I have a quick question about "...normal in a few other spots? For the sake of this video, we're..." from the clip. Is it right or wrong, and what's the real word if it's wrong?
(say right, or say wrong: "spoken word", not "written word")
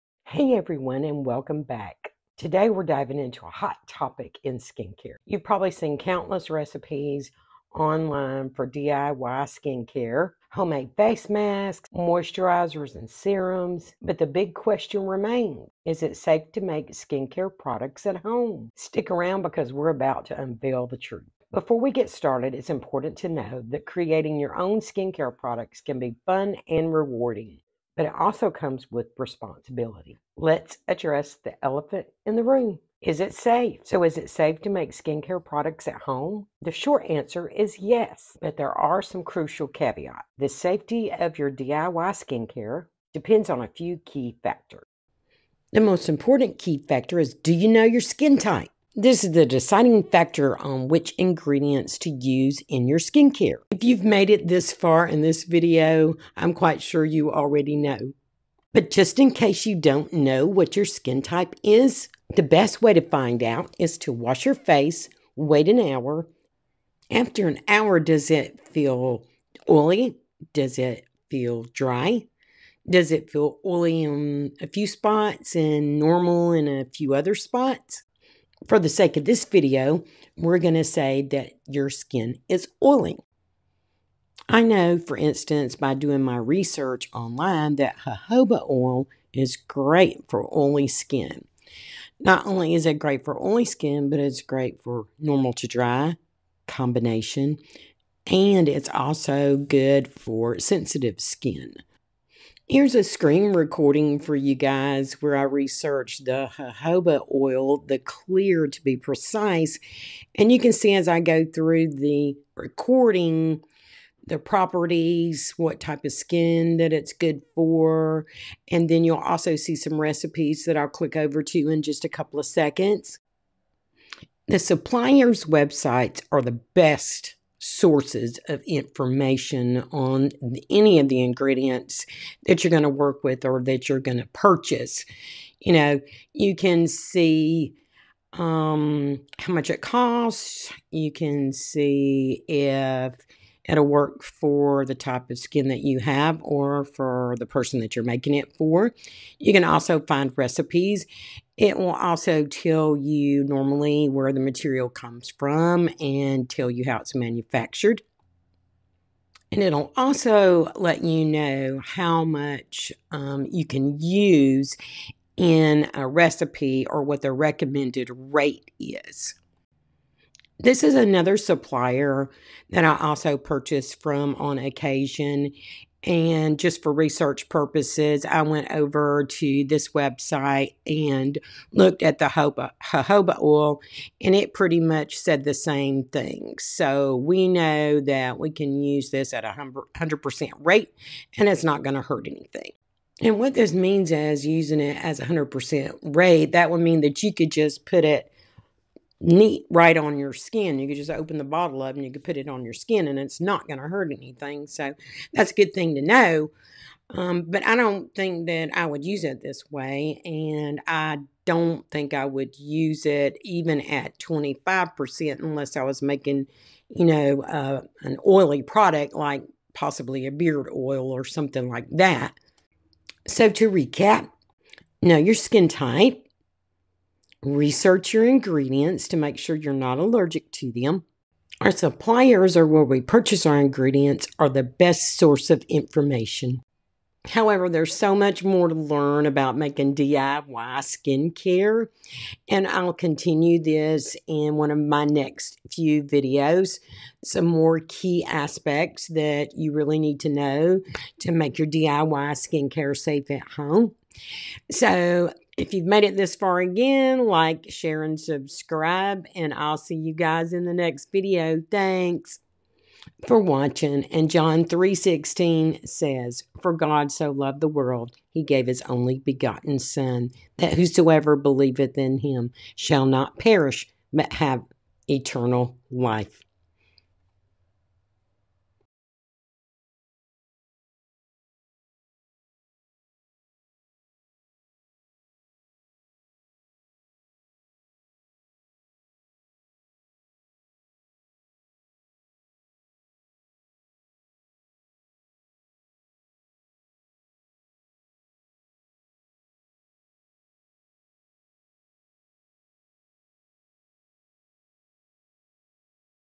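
right.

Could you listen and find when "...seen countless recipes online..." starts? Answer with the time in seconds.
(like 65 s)
5 s.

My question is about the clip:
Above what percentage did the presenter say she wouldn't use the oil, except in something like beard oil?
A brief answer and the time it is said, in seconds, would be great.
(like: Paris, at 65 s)
25%, at 214 s.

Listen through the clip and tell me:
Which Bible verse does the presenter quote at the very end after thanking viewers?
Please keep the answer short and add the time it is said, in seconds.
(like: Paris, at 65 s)
John 3:16, at 264 s.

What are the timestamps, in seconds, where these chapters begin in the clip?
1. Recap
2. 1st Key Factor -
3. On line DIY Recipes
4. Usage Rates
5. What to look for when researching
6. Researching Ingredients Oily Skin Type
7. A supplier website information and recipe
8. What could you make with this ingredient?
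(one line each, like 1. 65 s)
1. 228 s
2. 45 s
3. 10 s
4. 161 s
5. 111 s
6. 86 s
7. 149 s
8. 216 s.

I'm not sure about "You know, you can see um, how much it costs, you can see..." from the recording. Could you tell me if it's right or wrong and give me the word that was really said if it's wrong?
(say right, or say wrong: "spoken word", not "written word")
right.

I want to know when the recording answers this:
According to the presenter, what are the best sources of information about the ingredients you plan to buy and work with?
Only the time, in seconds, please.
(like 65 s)
124 s.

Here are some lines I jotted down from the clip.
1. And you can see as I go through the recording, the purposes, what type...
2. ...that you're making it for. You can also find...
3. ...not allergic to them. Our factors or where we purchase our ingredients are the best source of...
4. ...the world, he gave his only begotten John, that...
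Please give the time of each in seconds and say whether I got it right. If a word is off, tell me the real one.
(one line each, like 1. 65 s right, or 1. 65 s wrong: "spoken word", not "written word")
1. 110 s wrong: "properties", not "purposes"
2. 147 s right
3. 229 s wrong: "suppliers", not "factors"
4. 267 s wrong: "Son", not "John".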